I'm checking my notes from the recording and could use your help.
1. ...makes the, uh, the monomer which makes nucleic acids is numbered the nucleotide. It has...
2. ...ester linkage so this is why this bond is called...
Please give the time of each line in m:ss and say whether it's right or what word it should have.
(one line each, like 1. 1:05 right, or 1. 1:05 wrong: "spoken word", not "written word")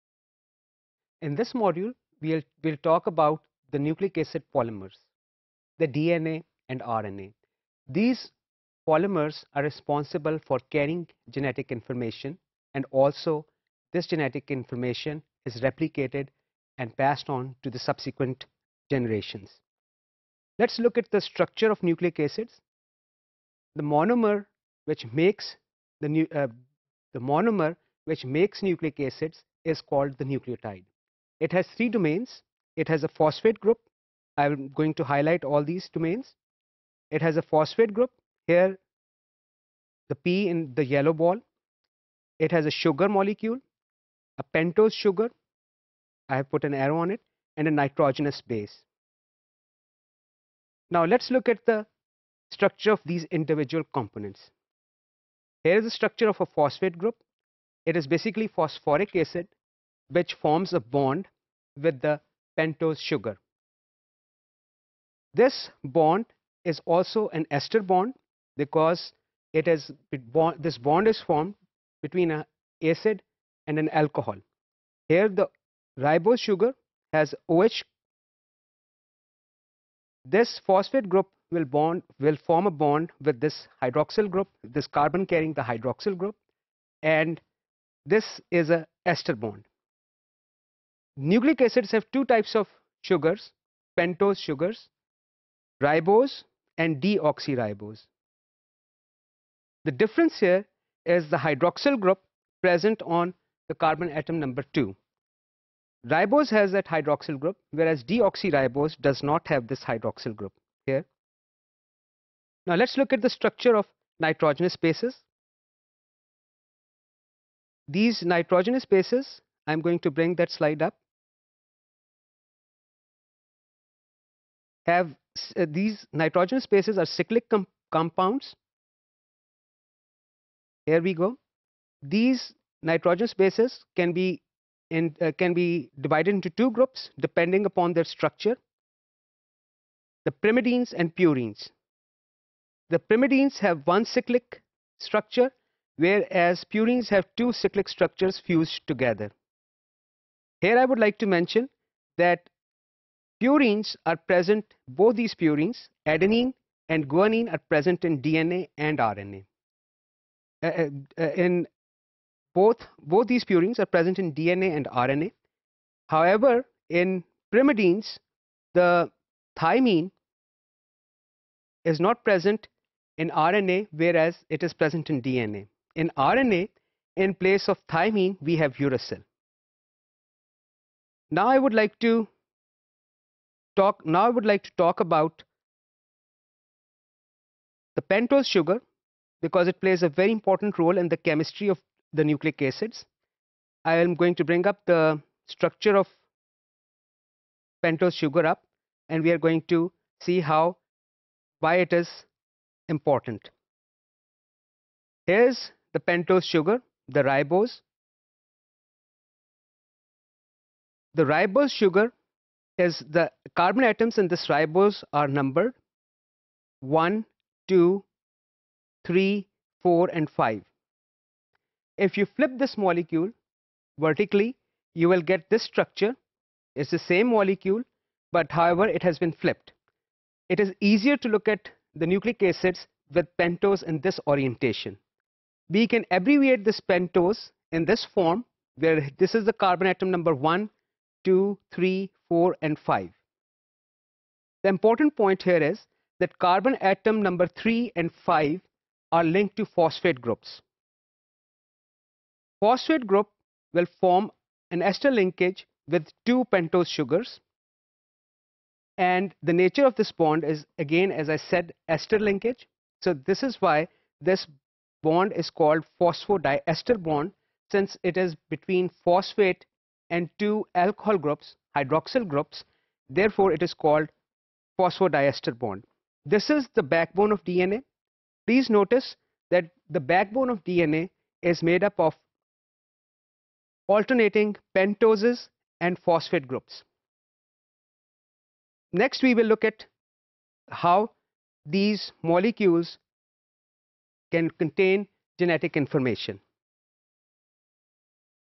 1. 0:25 wrong: "called", not "numbered"
2. 4:21 right.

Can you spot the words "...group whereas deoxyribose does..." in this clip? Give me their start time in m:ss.
1:47.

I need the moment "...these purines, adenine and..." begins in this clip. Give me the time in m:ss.
2:35.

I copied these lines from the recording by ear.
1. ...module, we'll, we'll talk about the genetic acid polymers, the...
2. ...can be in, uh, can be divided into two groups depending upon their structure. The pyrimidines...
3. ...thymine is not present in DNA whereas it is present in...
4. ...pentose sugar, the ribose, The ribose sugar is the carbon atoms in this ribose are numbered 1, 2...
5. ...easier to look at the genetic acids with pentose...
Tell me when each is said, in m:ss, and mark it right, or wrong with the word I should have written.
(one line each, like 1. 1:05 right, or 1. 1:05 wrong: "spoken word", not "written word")
1. 0:01 wrong: "nucleic", not "genetic"
2. 2:13 right
3. 2:49 wrong: "RNA", not "DNA"
4. 3:26 right
5. 3:50 wrong: "nucleic", not "genetic".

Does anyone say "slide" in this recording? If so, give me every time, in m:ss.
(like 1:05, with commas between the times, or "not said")
2:00.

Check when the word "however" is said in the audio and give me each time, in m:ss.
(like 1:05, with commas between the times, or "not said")
2:46, 3:48.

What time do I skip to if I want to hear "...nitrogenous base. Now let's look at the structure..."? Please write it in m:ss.
0:47.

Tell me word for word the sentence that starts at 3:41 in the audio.
If you flip this molecule vertically, you will get this structure.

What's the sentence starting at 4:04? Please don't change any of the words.
The important point here is that carbon atom number 3 and 5 are linked to phosphate groups.